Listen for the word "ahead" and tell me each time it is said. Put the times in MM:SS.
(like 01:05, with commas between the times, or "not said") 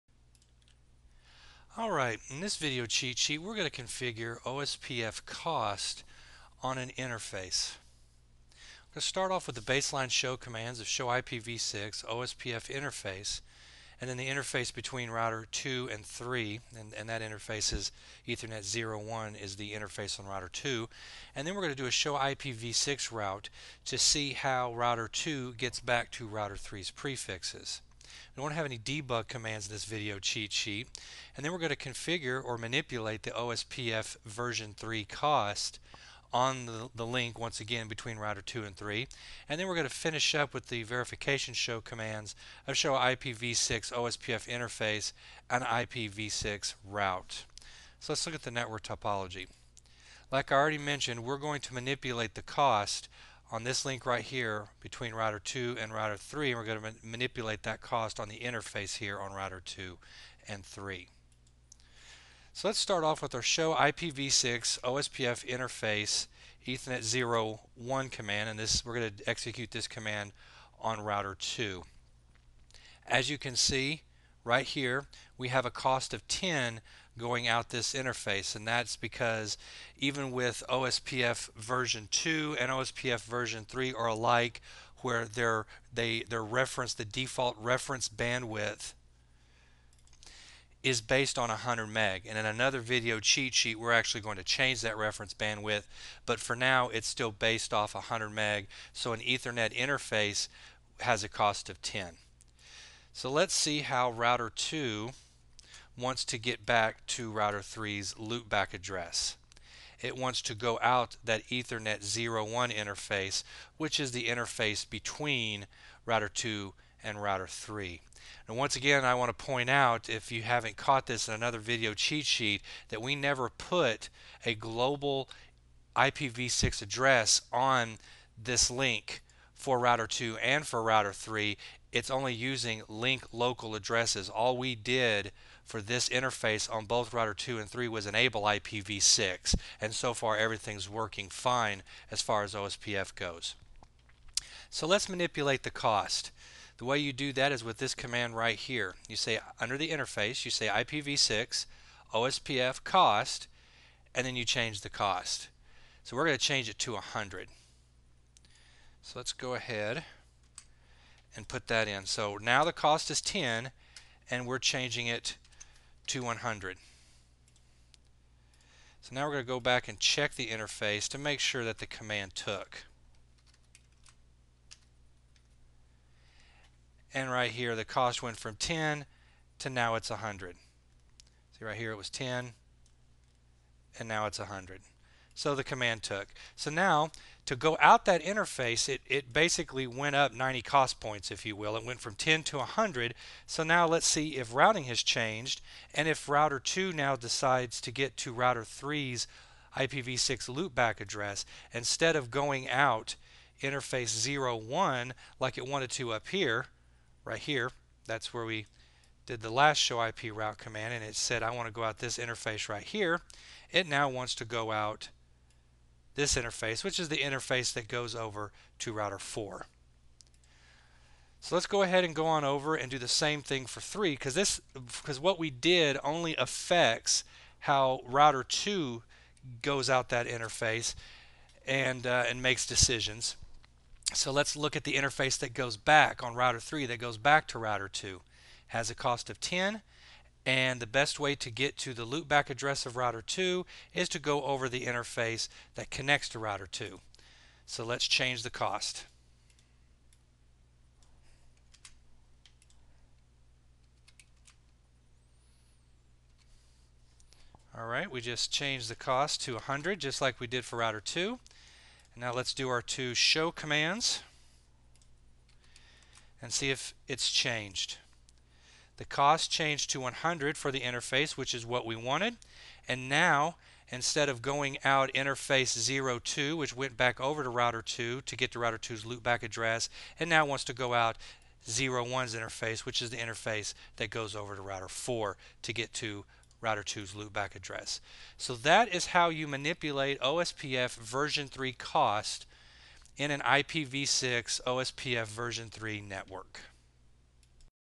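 02:39, 03:41.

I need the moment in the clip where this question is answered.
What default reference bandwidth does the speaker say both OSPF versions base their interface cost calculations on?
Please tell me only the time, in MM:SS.
01:30.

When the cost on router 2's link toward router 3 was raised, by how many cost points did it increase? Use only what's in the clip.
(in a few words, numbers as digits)
90.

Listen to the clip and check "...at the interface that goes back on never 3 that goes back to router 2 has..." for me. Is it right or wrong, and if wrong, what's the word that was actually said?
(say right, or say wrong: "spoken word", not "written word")
wrong: "router", not "never".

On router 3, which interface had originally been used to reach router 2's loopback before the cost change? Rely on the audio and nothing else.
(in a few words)
02.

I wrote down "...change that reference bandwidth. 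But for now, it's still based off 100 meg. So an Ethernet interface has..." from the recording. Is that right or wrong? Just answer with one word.
right.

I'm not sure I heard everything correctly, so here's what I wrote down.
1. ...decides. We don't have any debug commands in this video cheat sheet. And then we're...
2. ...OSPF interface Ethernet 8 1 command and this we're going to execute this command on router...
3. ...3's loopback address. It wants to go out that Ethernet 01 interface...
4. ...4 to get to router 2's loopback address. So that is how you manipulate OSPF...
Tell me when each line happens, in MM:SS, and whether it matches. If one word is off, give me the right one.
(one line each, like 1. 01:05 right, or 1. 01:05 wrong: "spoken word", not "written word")
1. 00:26 wrong: "prefixes", not "decides"
2. 01:04 wrong: "0", not "8"
3. 01:47 right
4. 04:44 right.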